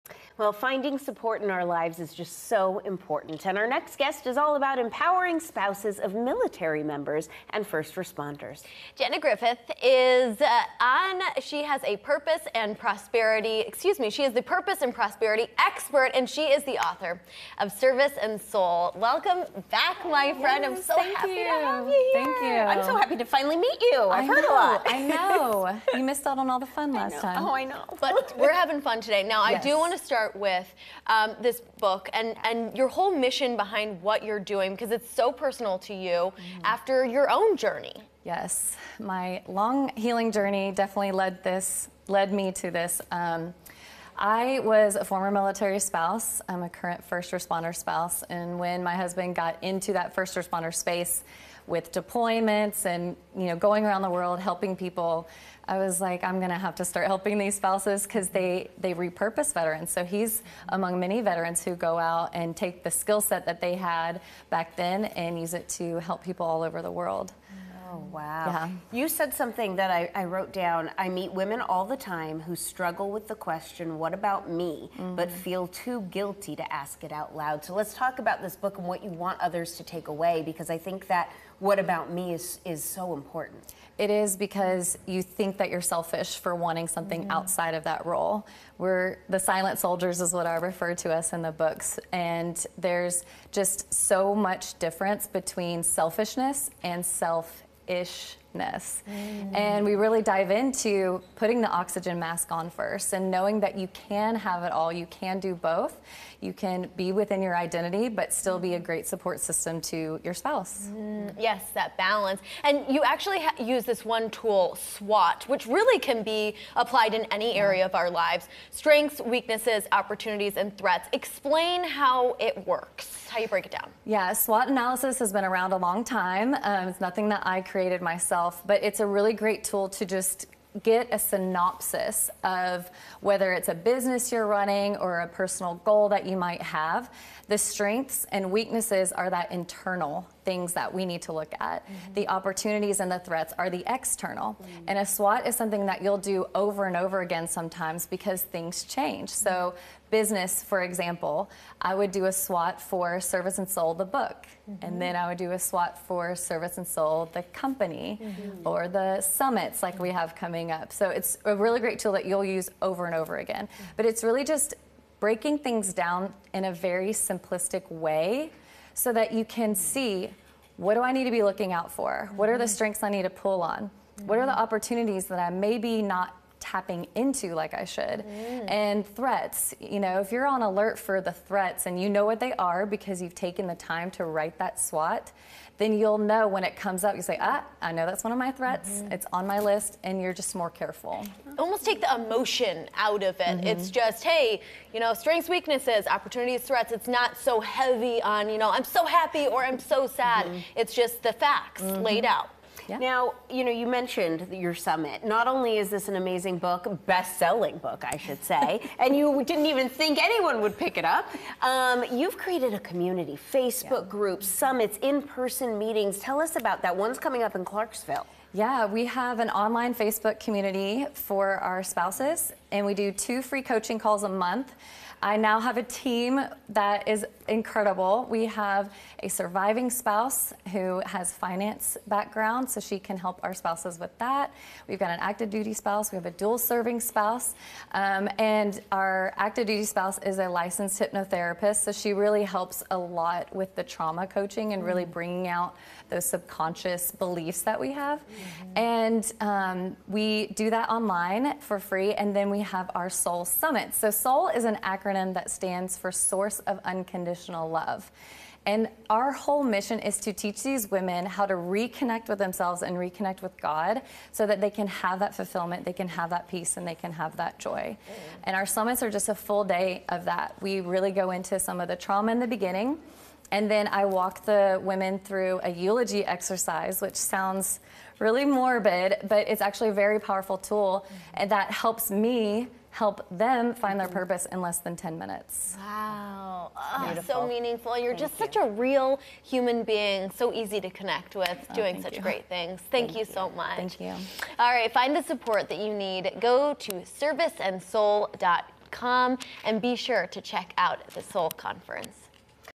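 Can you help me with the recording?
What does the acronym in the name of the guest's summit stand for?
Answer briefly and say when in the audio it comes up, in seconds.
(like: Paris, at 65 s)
Source of Unconditional Love, at 256 s.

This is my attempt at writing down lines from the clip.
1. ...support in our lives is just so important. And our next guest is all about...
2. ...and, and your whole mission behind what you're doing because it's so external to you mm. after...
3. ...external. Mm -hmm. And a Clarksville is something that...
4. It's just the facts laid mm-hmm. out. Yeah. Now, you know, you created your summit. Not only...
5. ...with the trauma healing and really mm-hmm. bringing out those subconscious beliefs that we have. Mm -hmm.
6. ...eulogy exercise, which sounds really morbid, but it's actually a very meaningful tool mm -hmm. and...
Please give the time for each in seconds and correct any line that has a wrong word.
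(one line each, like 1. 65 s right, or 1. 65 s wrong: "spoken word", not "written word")
1. 0 s right
2. 32 s wrong: "personal", not "external"
3. 143 s wrong: "SWOT", not "Clarksville"
4. 200 s wrong: "mentioned", not "created"
5. 243 s wrong: "coaching", not "healing"
6. 275 s wrong: "powerful", not "meaningful".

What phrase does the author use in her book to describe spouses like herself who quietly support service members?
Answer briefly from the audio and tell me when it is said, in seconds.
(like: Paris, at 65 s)
silent soldiers, at 89 s.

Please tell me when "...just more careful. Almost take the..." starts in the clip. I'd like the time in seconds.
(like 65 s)
190 s.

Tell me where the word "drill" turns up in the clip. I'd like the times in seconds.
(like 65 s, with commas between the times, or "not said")
not said.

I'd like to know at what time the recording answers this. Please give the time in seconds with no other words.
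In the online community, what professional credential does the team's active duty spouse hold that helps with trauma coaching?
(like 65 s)
240 s.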